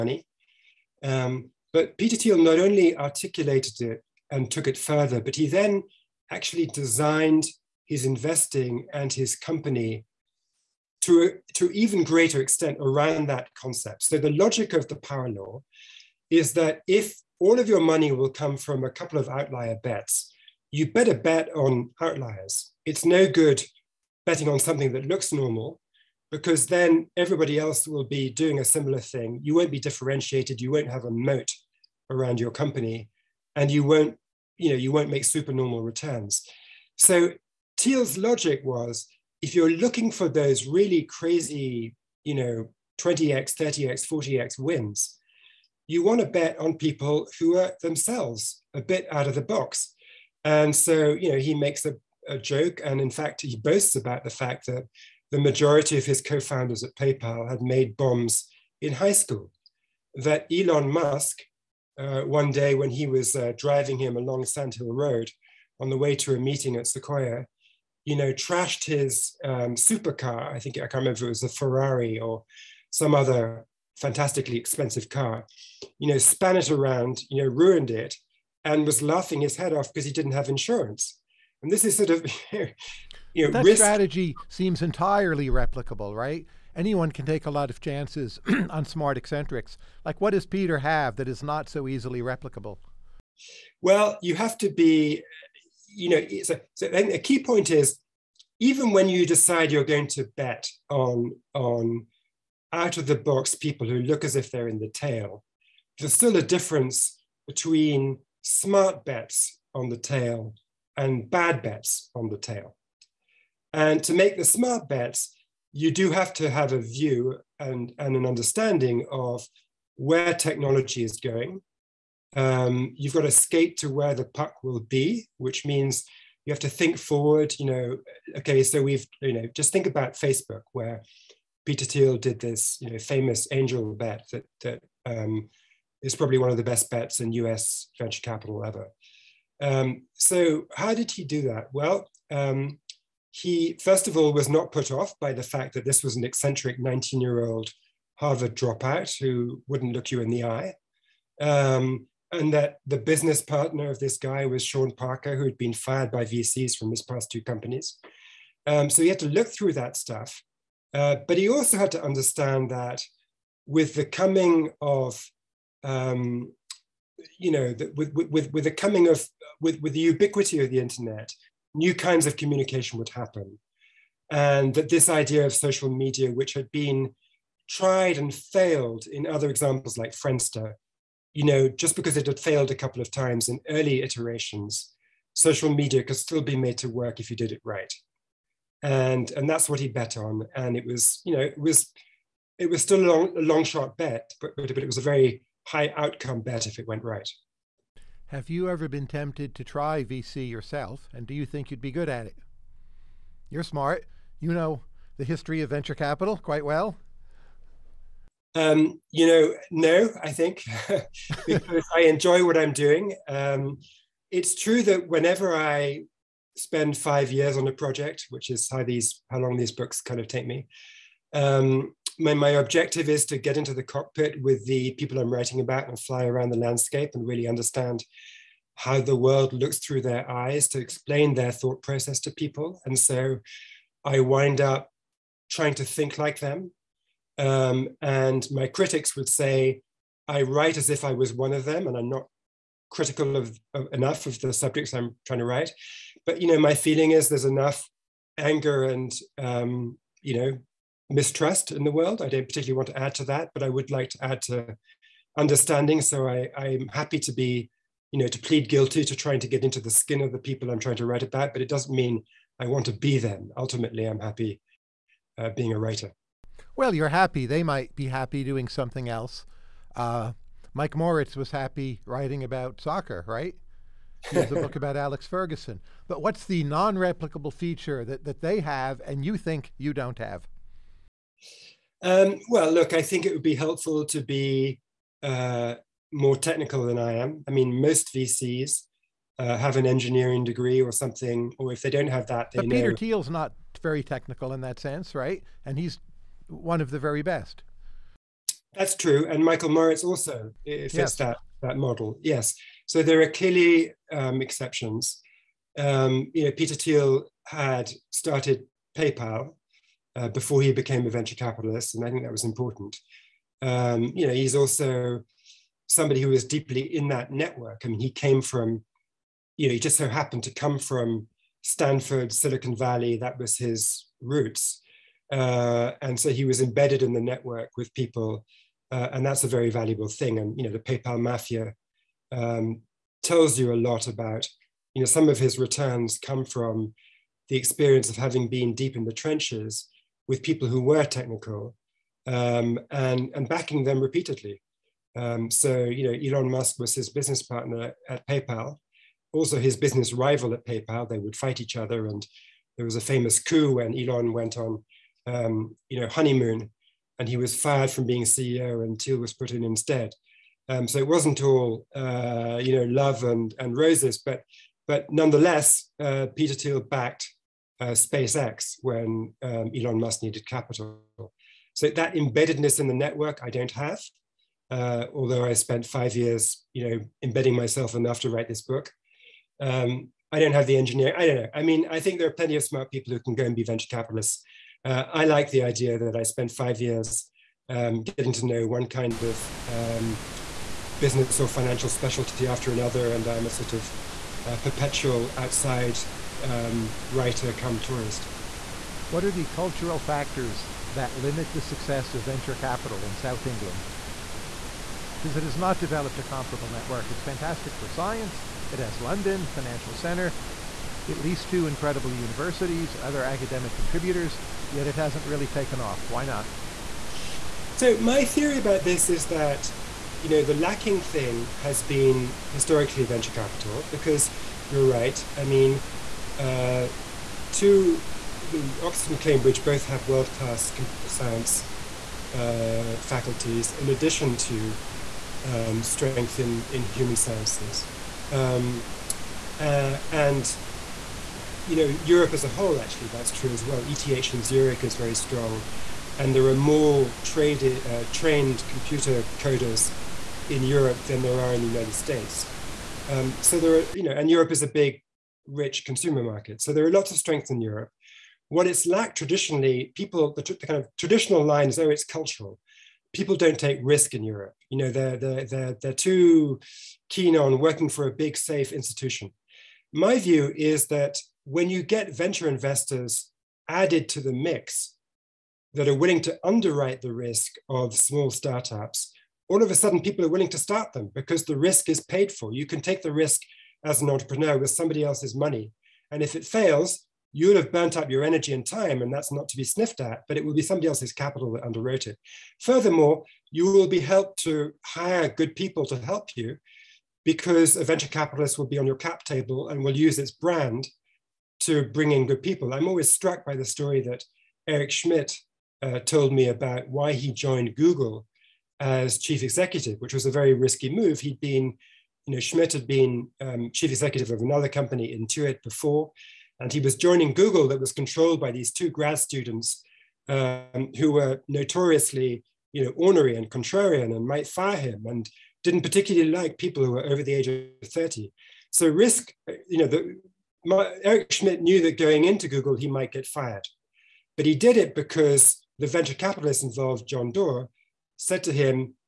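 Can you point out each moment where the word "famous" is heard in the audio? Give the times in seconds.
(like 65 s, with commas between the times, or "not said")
132 s, 353 s.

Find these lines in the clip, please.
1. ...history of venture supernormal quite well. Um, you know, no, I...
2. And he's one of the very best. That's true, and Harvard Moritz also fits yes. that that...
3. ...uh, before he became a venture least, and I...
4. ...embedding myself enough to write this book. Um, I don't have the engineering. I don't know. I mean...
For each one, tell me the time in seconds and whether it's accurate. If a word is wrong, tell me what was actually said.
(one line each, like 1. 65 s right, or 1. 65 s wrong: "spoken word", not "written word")
1. 205 s wrong: "capital", not "supernormal"
2. 295 s wrong: "Michael", not "Harvard"
3. 310 s wrong: "capitalist", not "least"
4. 377 s right.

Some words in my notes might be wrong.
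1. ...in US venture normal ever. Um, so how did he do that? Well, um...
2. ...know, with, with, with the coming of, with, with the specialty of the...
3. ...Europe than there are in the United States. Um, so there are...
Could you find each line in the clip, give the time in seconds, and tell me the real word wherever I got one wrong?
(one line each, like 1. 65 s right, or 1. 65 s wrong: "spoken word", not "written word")
1. 137 s wrong: "capital", not "normal"
2. 167 s wrong: "ubiquity", not "specialty"
3. 450 s right.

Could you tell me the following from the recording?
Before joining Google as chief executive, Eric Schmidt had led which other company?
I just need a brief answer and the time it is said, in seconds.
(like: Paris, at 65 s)
Intuit, at 515 s.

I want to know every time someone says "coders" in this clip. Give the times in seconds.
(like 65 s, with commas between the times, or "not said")
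449 s.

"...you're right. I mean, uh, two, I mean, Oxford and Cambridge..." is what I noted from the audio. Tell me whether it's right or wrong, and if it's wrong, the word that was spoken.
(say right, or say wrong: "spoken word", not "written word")
right.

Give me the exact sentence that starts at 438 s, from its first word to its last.
Um, uh, and you know, Europe as a whole, actually, that's true as well.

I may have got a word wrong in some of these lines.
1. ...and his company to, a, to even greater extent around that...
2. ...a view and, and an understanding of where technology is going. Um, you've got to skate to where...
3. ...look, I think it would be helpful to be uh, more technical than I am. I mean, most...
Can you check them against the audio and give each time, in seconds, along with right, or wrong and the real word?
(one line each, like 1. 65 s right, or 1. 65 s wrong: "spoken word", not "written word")
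1. 8 s right
2. 116 s right
3. 282 s right.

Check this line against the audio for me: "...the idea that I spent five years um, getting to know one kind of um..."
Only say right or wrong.
right.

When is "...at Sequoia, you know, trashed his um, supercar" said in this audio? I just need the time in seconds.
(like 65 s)
66 s.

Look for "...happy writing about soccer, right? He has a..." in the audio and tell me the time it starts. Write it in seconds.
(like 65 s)
271 s.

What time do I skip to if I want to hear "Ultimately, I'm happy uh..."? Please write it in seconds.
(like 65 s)
263 s.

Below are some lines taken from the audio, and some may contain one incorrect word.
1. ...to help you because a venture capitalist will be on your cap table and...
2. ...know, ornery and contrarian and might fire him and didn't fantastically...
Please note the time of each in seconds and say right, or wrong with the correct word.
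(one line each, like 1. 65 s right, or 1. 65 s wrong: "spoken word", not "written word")
1. 495 s right
2. 522 s wrong: "particularly", not "fantastically".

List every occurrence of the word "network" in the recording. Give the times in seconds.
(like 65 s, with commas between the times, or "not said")
317 s, 327 s, 372 s, 406 s.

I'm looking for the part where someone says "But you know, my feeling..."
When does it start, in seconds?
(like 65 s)
246 s.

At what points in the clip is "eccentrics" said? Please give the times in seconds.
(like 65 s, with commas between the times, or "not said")
89 s, 146 s.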